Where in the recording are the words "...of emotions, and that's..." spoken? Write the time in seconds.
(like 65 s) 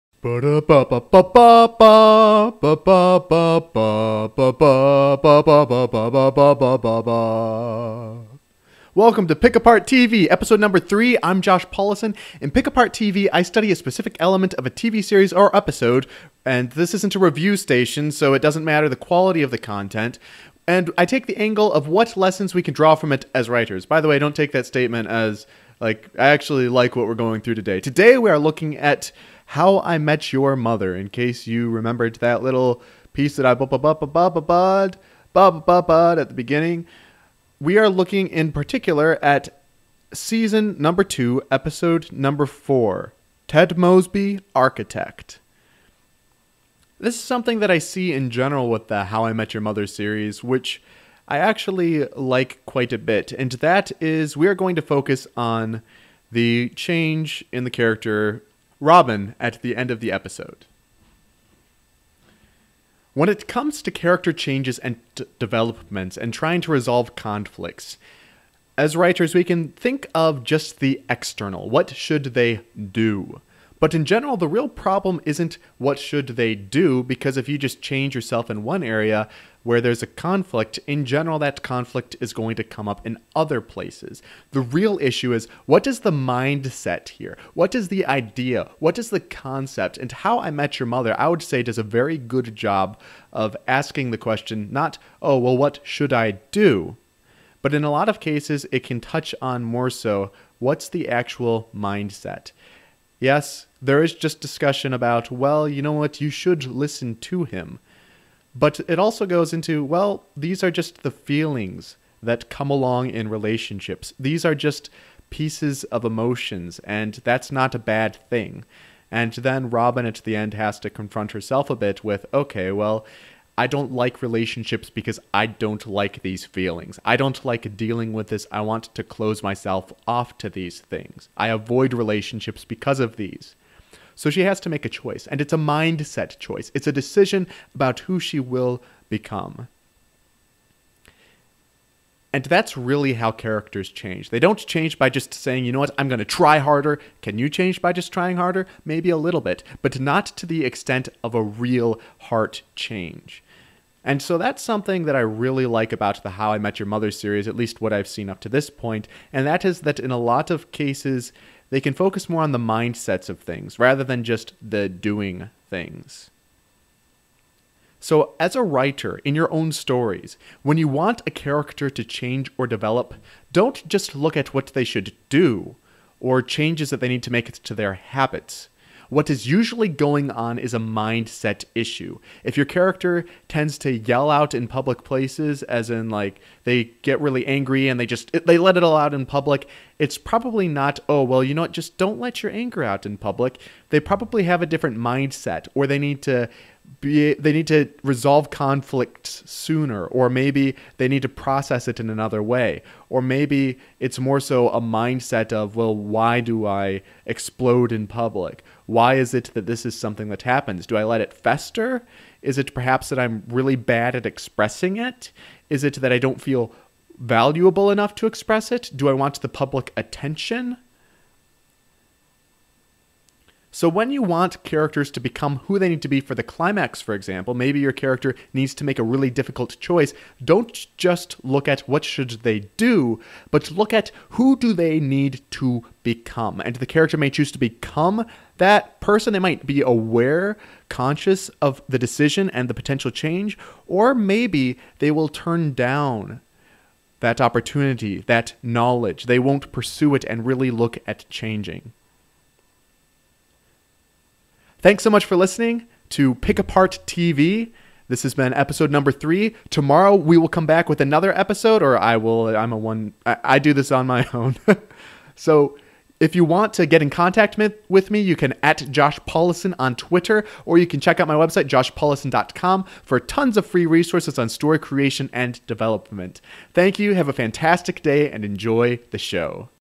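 115 s.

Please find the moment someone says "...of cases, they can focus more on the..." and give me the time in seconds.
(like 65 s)
160 s.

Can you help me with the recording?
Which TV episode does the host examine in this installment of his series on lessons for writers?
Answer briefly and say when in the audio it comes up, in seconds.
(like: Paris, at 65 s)
Ted Mosby, Architect, at 43 s.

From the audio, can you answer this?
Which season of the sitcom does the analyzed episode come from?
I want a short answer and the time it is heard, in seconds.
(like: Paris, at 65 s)
2, at 41 s.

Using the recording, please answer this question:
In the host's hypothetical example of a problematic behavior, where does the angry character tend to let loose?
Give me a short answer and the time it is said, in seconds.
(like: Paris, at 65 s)
Public places, at 184 s.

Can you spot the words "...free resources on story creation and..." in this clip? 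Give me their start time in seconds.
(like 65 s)
273 s.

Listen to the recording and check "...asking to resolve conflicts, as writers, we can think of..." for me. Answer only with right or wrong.
wrong.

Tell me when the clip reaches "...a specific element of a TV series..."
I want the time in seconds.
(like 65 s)
13 s.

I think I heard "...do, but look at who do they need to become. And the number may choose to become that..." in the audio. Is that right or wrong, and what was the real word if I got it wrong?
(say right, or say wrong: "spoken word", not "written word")
wrong: "character", not "number".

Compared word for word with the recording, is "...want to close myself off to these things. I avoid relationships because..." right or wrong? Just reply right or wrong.
right.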